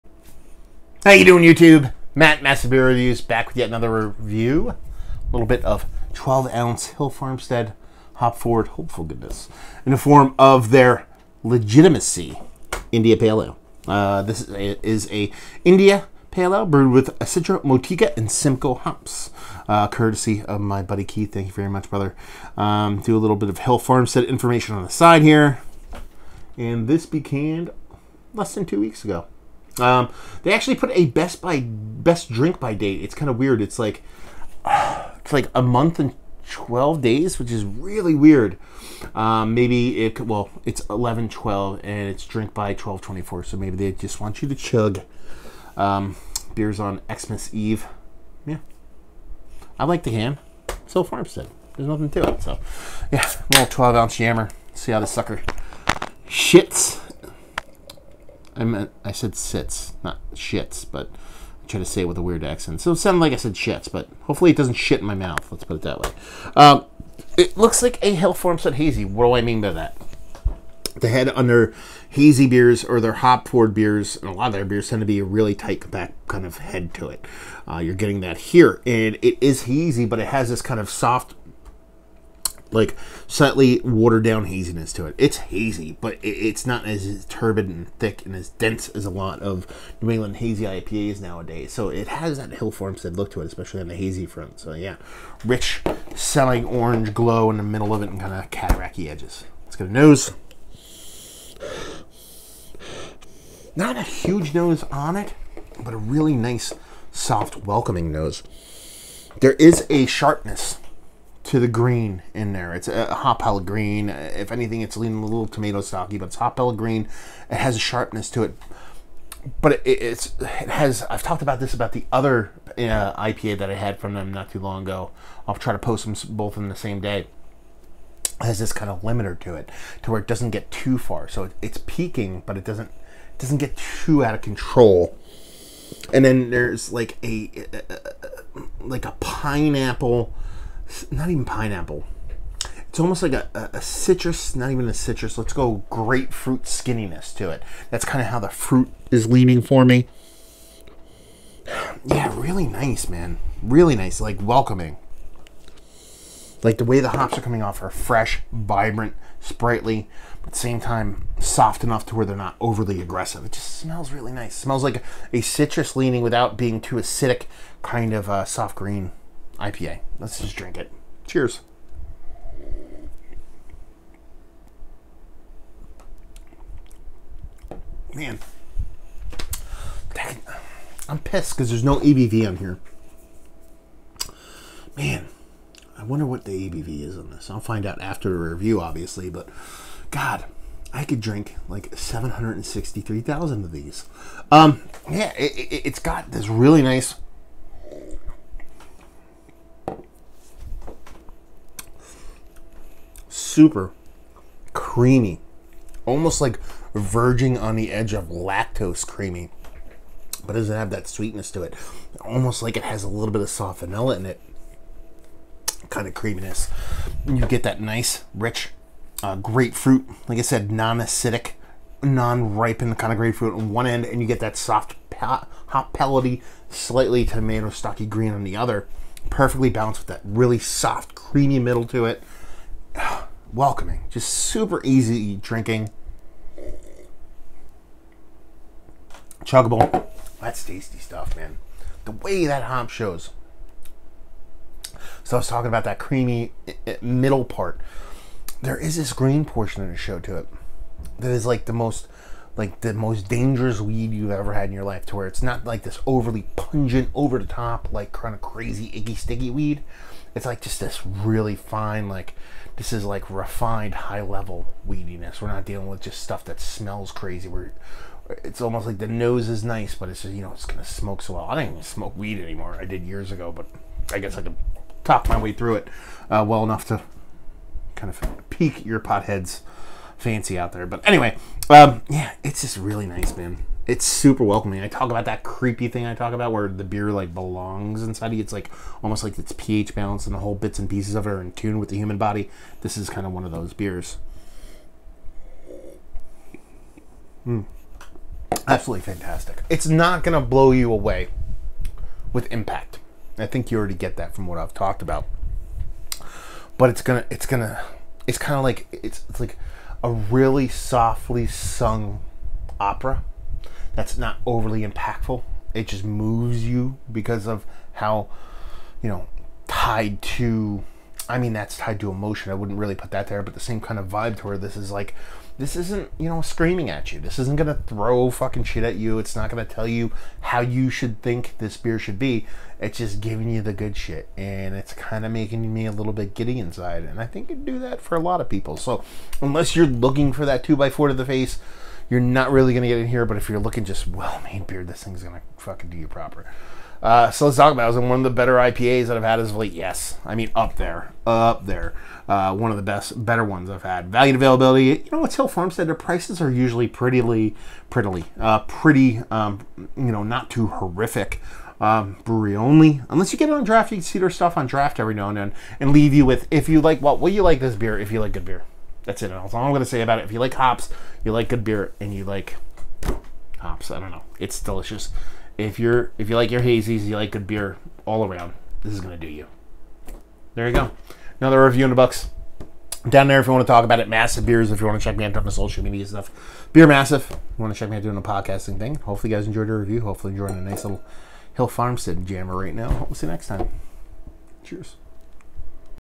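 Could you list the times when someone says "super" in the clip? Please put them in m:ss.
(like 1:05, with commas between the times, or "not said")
3:23, 3:54, 4:44.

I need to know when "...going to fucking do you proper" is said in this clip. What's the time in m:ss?
5:45.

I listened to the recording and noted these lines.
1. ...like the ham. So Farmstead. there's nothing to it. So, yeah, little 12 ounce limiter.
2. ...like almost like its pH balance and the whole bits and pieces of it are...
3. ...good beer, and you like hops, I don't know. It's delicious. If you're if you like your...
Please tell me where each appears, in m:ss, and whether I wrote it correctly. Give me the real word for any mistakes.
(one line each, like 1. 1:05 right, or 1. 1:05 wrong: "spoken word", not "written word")
1. 0:49 wrong: "yammer", not "limiter"
2. 4:48 right
3. 6:11 right.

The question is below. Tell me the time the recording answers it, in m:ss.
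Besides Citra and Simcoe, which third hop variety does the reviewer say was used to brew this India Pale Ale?
0:17.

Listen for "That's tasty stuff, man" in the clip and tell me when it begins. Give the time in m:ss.
4:00.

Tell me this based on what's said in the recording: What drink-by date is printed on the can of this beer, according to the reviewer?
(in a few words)
12/24.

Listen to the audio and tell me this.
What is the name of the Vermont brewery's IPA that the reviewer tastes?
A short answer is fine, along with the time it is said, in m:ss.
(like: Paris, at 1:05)
Legitimacy, at 0:11.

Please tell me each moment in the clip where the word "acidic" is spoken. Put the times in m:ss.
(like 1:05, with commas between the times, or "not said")
2:46, 3:40.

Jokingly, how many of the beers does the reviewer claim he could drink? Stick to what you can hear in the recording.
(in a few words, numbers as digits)
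763,000.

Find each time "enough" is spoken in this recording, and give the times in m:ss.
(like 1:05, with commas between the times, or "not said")
2:41, 4:36.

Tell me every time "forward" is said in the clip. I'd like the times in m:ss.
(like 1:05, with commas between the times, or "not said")
0:08, 1:13.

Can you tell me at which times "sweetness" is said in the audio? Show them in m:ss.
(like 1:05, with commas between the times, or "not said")
3:31.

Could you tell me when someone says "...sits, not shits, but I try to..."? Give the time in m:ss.
0:59.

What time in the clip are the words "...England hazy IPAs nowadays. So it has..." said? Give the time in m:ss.
1:30.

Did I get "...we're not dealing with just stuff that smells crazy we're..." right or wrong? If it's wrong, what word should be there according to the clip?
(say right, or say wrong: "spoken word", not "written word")
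right.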